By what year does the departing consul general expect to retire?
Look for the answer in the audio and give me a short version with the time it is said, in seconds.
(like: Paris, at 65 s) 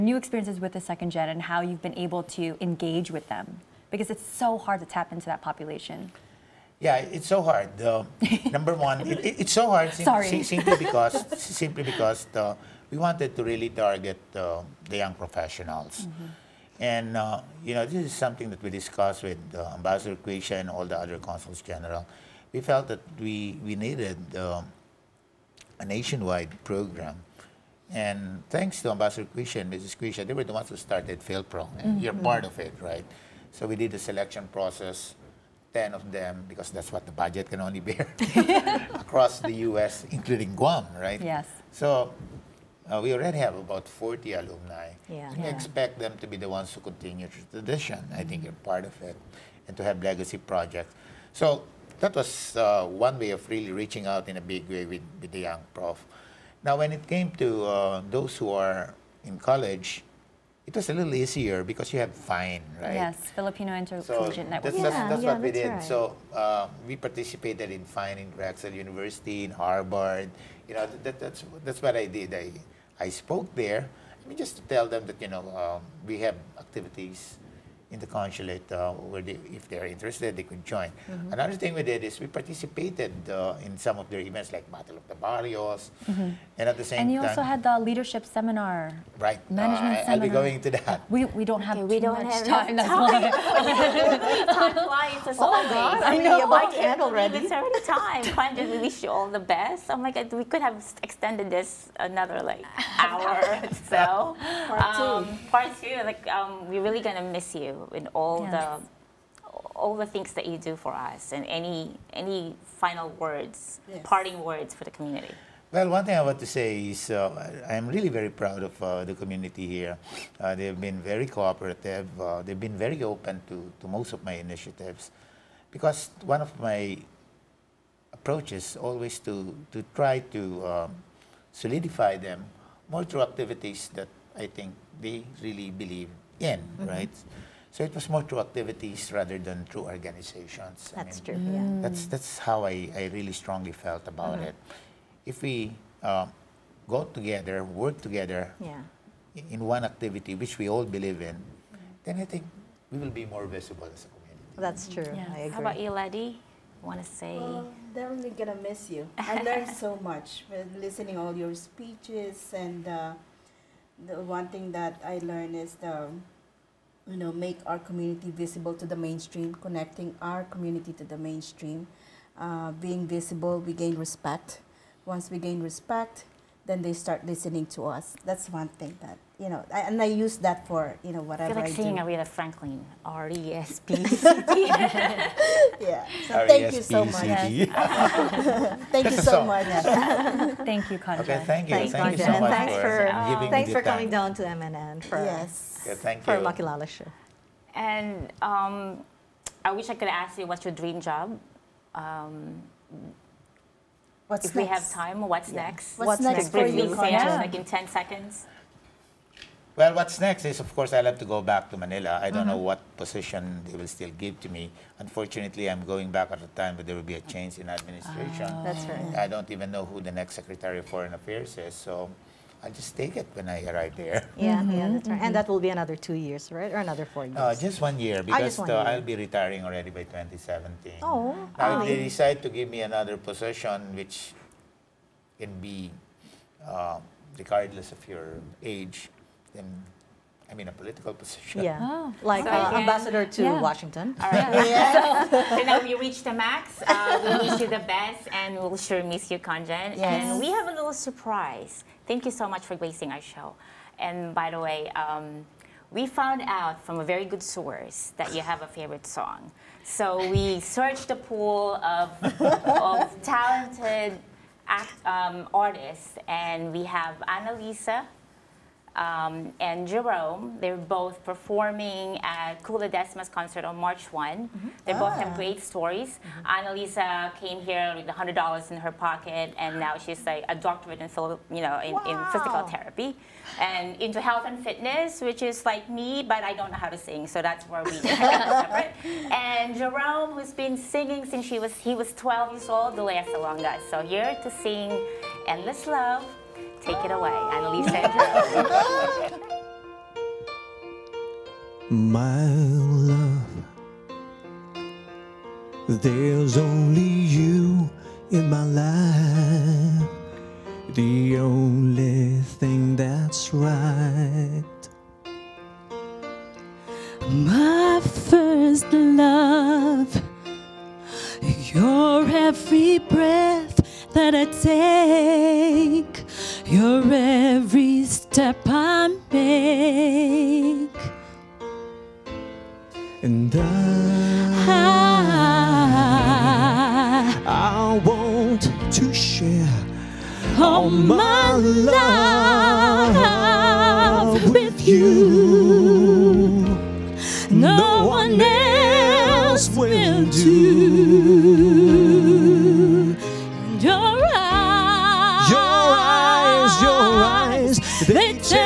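2017, at 230 s.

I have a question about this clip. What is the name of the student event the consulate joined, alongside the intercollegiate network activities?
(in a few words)
Battle of the Barrios.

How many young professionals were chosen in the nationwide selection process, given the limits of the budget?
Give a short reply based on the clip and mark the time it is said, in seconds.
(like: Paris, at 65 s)
10, at 35 s.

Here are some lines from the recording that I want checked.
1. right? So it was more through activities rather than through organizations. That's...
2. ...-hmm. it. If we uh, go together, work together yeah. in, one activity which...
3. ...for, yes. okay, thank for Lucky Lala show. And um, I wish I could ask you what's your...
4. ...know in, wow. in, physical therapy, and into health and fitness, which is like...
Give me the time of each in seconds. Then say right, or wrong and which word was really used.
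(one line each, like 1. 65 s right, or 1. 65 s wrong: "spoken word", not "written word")
1. 136 s right
2. 144 s right
3. 195 s right
4. 281 s right.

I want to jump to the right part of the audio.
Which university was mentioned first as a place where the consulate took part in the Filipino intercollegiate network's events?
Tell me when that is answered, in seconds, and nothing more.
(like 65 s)
68 s.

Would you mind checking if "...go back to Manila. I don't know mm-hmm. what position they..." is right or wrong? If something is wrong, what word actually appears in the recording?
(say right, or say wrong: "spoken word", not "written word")
right.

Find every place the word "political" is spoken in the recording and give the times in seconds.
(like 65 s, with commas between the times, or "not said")
240 s.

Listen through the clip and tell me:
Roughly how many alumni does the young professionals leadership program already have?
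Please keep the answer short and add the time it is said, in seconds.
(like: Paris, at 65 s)
40, at 43 s.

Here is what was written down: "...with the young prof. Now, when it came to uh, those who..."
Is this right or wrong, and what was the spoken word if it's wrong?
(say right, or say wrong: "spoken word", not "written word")
right.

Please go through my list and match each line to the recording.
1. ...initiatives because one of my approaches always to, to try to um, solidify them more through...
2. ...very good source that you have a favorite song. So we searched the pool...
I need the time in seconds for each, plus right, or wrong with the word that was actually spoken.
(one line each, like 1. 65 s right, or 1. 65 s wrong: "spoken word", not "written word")
1. 124 s right
2. 257 s right.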